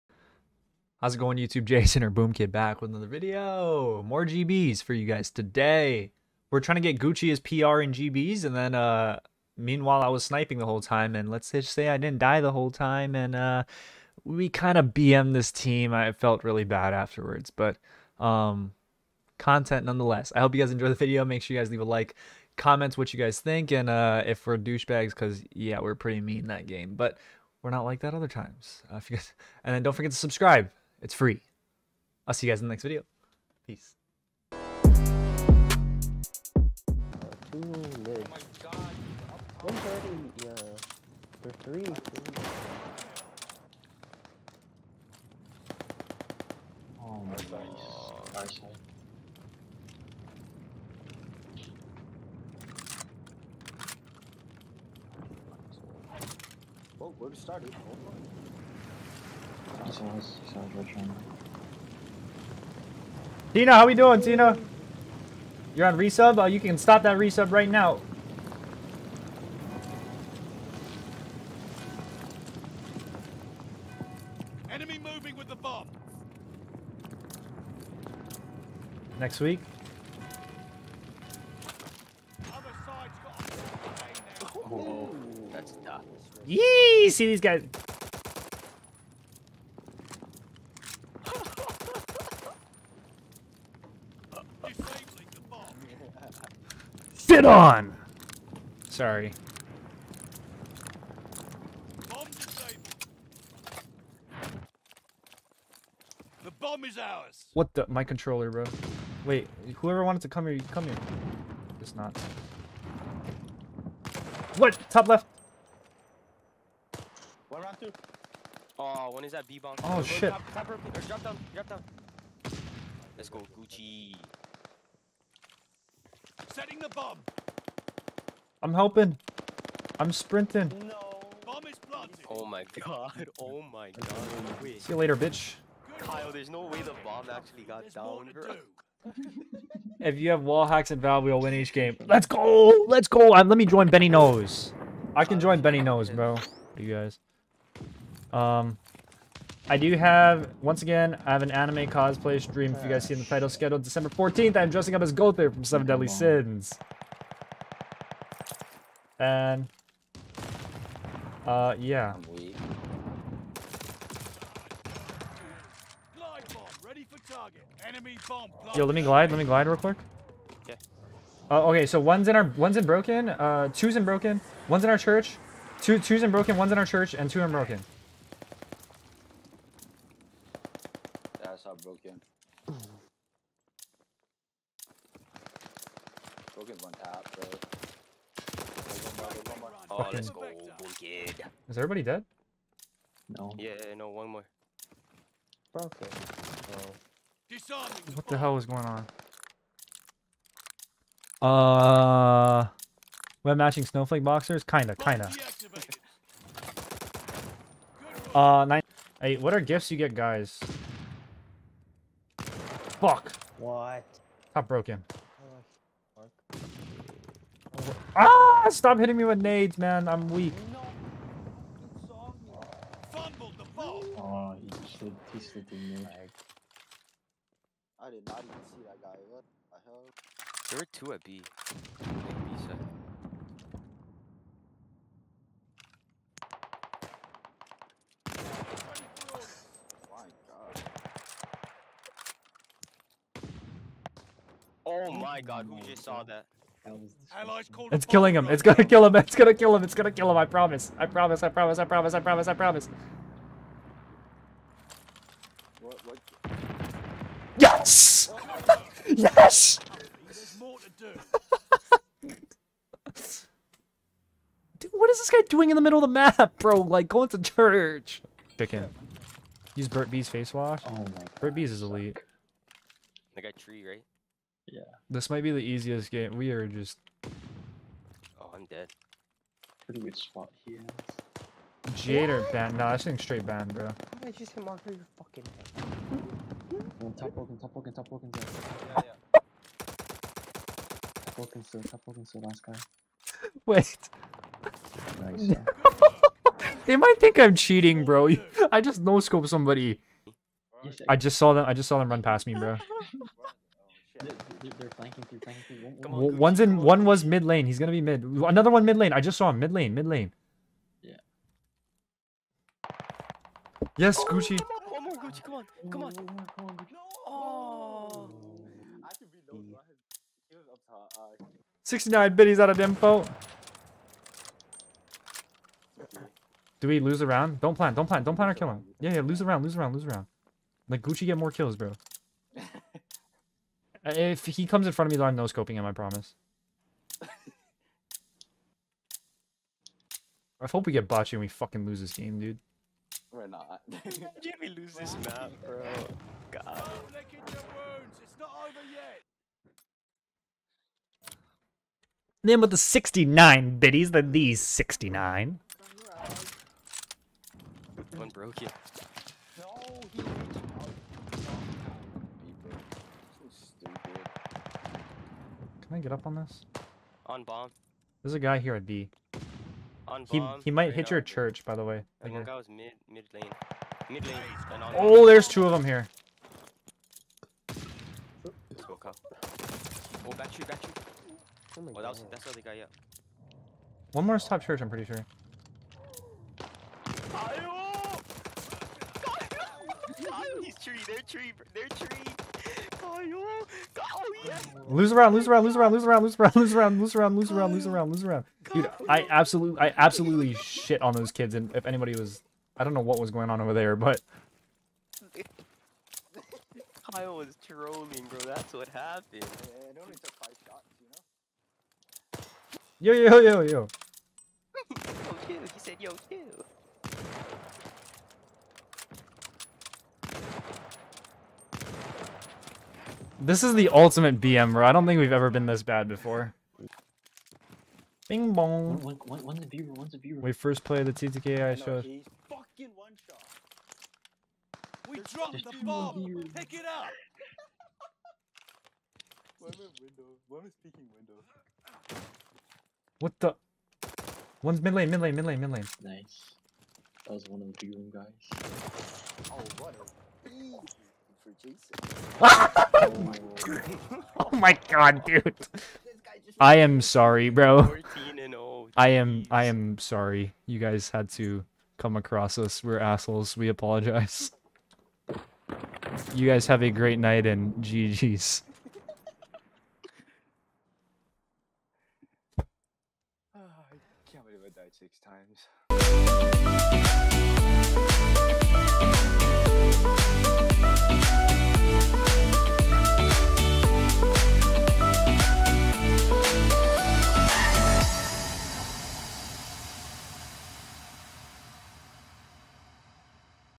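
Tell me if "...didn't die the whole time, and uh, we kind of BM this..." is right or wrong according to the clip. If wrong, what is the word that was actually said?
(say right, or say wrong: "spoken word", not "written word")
right.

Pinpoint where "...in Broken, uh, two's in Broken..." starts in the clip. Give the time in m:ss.
2:52.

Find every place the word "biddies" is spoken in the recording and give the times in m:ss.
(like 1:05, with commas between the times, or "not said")
5:22, 5:53.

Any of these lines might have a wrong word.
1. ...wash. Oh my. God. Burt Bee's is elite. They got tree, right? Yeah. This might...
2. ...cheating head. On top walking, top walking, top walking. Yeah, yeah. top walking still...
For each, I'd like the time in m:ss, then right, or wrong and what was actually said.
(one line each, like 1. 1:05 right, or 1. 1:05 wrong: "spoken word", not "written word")
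1. 4:30 right
2. 4:45 wrong: "fucking", not "cheating".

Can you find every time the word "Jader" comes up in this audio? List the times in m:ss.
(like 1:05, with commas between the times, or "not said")
4:41.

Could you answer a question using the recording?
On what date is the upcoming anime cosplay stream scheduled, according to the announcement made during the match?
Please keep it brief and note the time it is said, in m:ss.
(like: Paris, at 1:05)
December 14th, at 2:33.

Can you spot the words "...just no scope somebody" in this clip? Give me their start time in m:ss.
4:58.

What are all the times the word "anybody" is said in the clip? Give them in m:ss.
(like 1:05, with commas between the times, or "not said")
6:41.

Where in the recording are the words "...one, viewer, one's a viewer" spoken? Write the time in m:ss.
7:09.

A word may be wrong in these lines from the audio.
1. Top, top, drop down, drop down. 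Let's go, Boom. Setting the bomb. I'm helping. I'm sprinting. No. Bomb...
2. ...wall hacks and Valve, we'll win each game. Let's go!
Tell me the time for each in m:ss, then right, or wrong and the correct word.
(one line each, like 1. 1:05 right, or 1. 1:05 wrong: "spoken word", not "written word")
1. 2:00 wrong: "Gucci", not "Boom"
2. 2:20 right.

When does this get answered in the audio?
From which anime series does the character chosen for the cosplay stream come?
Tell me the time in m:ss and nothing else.
2:35.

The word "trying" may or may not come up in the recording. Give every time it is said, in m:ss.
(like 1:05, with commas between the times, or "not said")
0:06.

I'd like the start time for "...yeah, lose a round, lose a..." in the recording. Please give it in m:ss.
5:29.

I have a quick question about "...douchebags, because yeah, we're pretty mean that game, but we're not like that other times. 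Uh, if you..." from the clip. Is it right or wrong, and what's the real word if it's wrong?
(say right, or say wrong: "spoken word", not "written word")
right.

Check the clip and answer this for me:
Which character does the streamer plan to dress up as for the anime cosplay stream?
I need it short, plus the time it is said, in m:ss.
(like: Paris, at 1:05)
Gowther, at 2:35.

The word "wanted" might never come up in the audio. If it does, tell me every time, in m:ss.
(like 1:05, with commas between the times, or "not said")
1:50.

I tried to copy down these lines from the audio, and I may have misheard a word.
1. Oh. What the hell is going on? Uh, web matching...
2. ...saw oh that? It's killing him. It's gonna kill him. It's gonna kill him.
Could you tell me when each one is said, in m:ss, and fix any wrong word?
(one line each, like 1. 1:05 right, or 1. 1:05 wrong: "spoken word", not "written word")
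1. 3:15 right
2. 4:06 right.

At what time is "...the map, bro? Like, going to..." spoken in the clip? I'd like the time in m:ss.
4:26.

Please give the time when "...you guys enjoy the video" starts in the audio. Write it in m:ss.
0:20.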